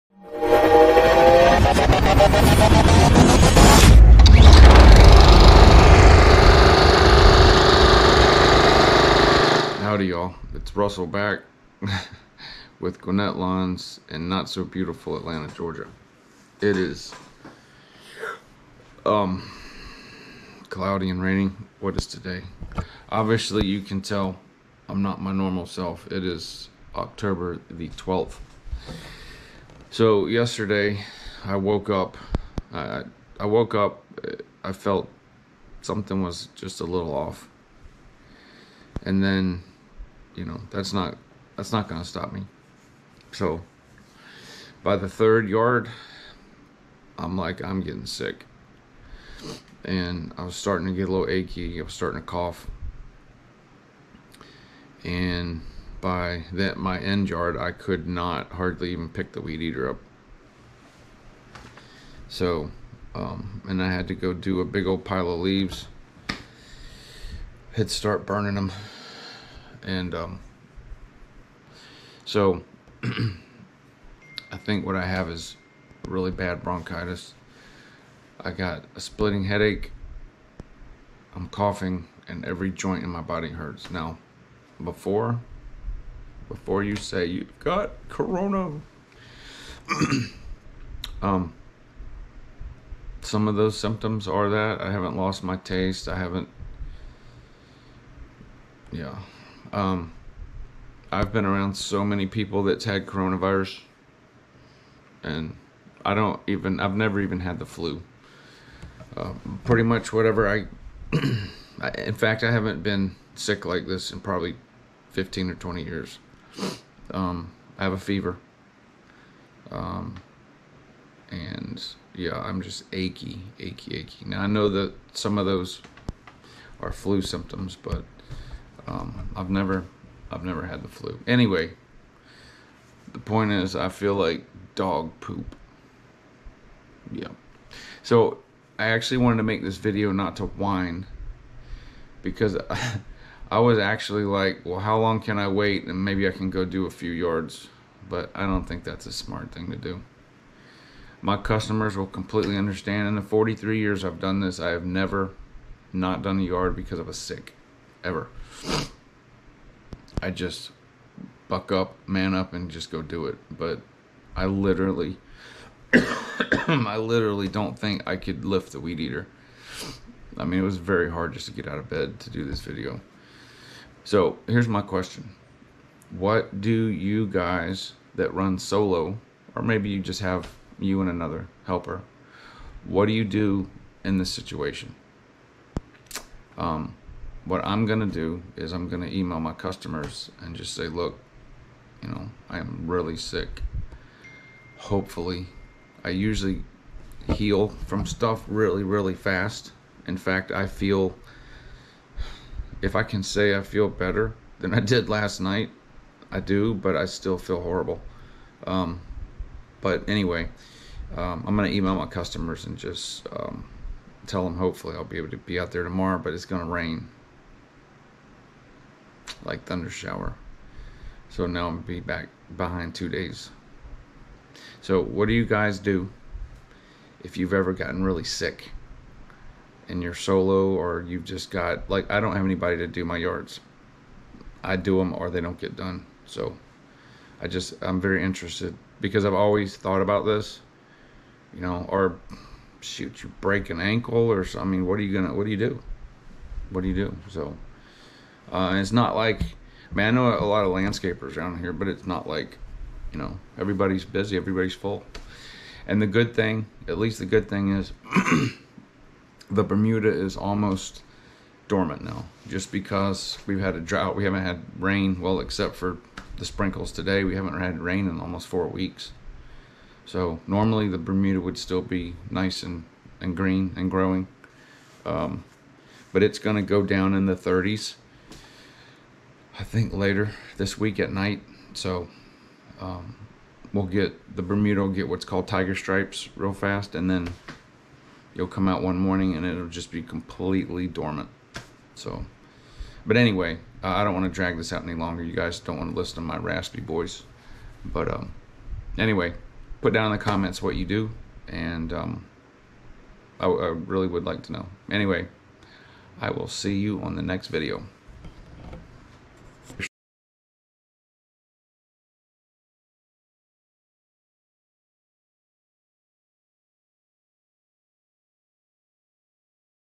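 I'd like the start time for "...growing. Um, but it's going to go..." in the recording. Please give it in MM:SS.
04:33.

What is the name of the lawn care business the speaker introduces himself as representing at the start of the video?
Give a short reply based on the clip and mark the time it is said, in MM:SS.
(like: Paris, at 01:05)
Gwinnett Lawns, at 00:13.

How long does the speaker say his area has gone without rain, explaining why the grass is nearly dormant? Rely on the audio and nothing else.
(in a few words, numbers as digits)
Four weeks.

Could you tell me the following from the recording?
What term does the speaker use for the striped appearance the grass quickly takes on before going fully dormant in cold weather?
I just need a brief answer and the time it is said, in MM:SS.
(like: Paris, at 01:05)
Tiger stripes, at 04:45.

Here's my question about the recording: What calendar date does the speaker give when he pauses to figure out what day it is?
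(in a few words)
October 12th.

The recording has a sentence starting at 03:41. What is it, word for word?
So now I'm be back behind two days.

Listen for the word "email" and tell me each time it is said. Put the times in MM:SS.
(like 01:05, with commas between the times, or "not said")
03:09, 03:31.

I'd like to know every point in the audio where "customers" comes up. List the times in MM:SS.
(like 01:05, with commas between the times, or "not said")
02:31, 03:09, 03:32.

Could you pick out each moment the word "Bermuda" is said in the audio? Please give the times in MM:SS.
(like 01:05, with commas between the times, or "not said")
04:19, 04:30, 04:44.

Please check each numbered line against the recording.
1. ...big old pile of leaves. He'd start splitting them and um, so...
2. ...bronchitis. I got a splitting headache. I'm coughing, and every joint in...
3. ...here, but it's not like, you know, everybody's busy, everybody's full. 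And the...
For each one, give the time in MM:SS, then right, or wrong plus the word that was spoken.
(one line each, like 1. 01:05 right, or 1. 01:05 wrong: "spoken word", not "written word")
1. 01:04 wrong: "burning", not "splitting"
2. 01:16 right
3. 04:11 right.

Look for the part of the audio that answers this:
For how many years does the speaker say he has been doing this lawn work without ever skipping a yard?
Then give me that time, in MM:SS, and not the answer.
02:33.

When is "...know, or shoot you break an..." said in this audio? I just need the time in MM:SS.
04:01.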